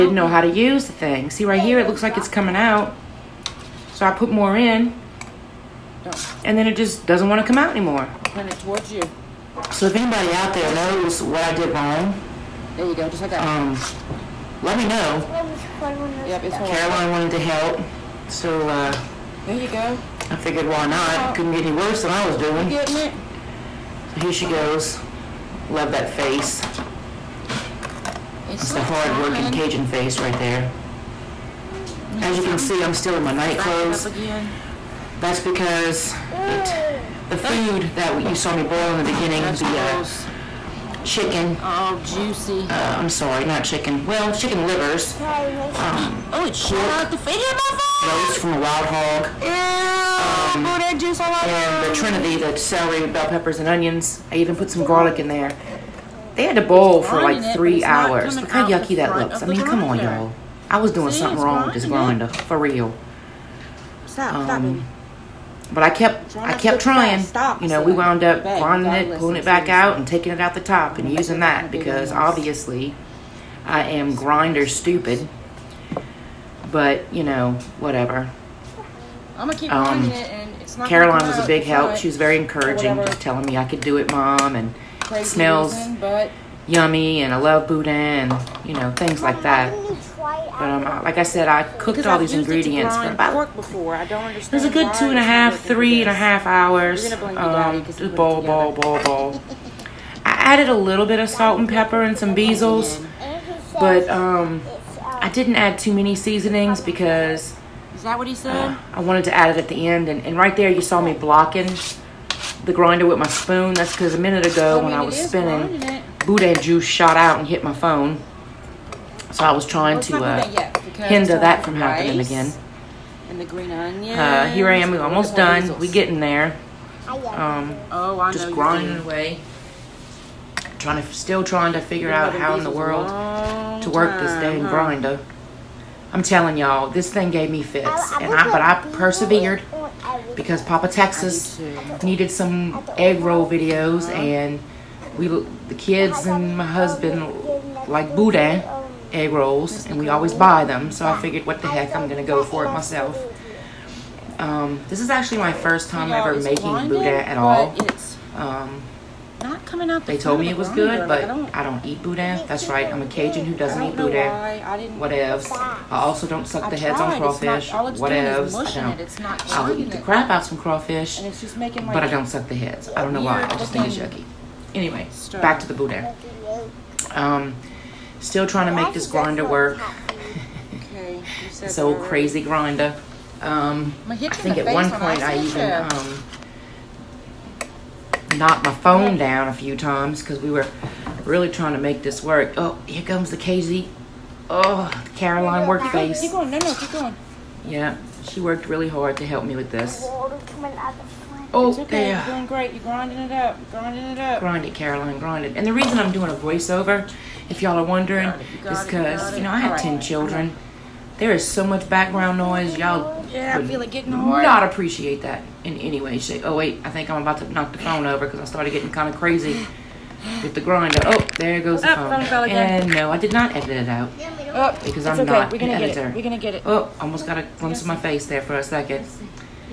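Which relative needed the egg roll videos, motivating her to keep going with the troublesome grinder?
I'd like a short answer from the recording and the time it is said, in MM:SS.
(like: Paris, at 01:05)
Papa Texas, at 02:20.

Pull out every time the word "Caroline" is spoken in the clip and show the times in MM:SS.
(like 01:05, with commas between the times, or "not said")
00:16, 01:20, 03:15, 03:24.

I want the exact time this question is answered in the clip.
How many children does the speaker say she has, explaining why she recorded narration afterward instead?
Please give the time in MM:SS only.
03:29.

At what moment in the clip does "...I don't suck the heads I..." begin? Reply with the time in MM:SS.
02:52.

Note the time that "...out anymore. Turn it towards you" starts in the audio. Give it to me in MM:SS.
00:07.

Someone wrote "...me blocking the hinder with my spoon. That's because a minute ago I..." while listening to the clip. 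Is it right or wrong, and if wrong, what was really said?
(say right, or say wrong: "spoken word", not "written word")
wrong: "grinder", not "hinder".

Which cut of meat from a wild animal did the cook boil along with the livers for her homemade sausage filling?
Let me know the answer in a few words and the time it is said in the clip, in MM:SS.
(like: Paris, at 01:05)
Roast from a wild hog, at 00:48.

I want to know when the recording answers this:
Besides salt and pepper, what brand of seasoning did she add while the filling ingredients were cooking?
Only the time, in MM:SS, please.
01:42.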